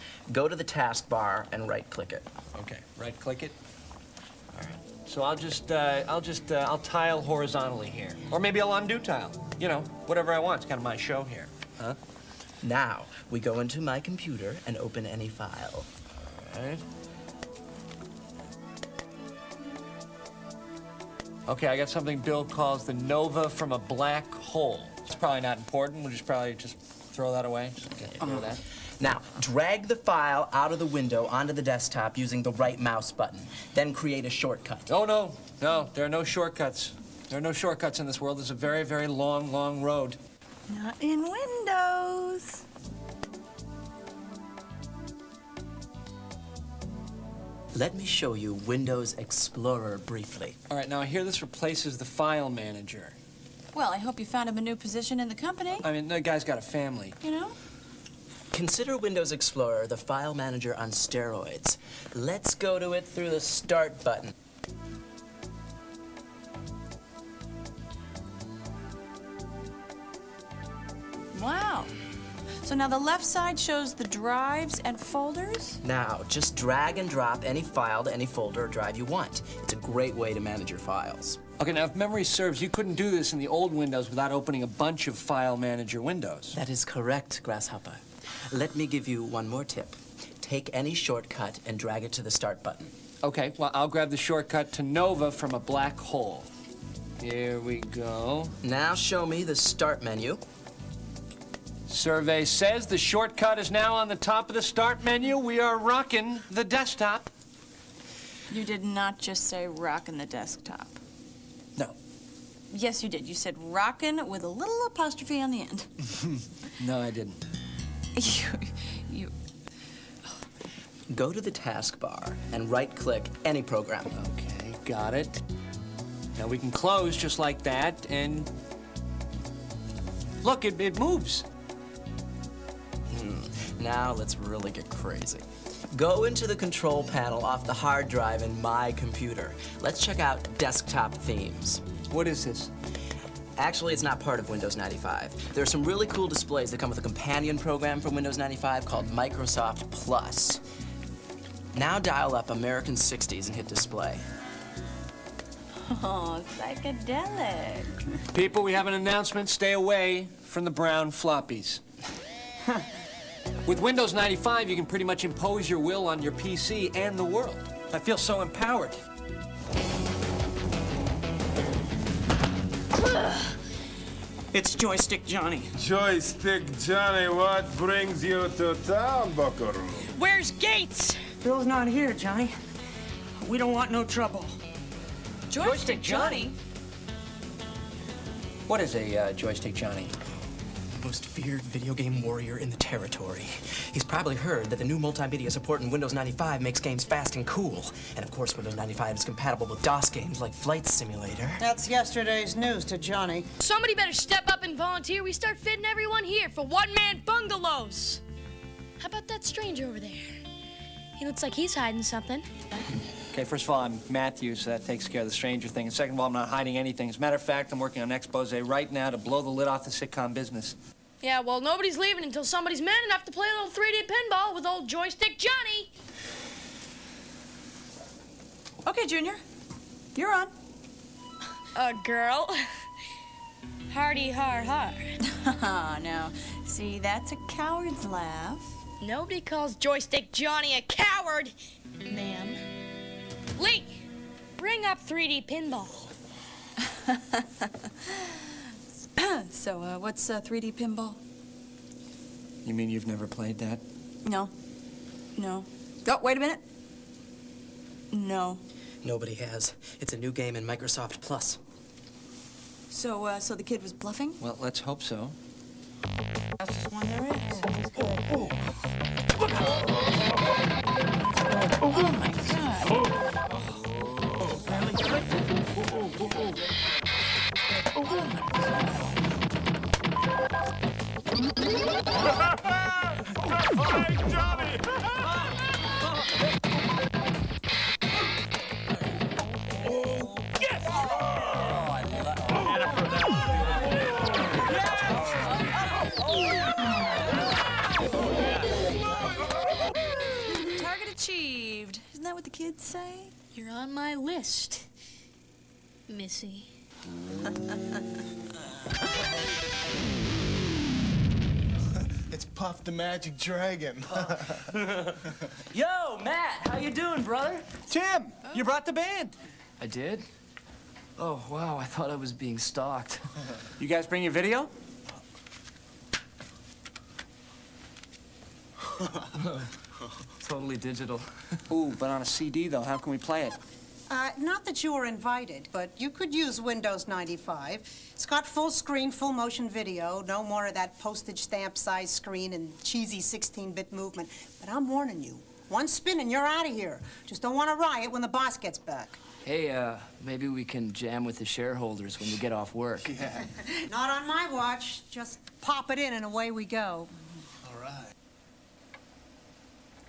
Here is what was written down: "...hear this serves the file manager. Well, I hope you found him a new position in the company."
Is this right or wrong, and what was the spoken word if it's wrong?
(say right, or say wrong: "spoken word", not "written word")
wrong: "replaces", not "serves".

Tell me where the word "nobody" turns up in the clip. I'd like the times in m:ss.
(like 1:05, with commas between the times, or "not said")
3:41, 3:59, 4:19.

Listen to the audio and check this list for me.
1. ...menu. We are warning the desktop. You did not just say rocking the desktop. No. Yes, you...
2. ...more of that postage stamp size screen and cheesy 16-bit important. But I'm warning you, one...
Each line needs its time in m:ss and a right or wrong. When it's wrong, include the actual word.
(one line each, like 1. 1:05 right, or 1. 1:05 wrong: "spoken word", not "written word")
1. 1:45 wrong: "rocking", not "warning"
2. 5:40 wrong: "movement", not "important".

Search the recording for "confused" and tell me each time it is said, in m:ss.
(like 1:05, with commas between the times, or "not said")
not said.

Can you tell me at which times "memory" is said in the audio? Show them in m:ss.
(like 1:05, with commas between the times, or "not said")
1:21.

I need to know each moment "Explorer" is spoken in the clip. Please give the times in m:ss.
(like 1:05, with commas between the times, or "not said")
0:49, 0:59.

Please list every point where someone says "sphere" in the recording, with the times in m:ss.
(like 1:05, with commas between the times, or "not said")
not said.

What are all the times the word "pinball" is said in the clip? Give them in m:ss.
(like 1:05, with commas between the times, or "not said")
3:44, 4:05, 4:10.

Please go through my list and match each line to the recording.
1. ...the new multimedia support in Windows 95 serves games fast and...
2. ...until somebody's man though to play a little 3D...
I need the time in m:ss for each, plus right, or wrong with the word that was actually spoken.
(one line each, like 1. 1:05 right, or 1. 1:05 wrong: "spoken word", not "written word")
1. 3:14 wrong: "makes", not "serves"
2. 3:42 wrong: "enough", not "though".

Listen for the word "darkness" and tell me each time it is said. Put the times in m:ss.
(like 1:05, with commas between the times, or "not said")
not said.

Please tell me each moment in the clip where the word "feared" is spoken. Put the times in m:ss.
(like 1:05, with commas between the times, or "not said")
3:11.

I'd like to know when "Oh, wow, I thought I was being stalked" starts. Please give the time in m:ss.
5:21.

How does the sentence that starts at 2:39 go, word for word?
Stay away from the brown floppies.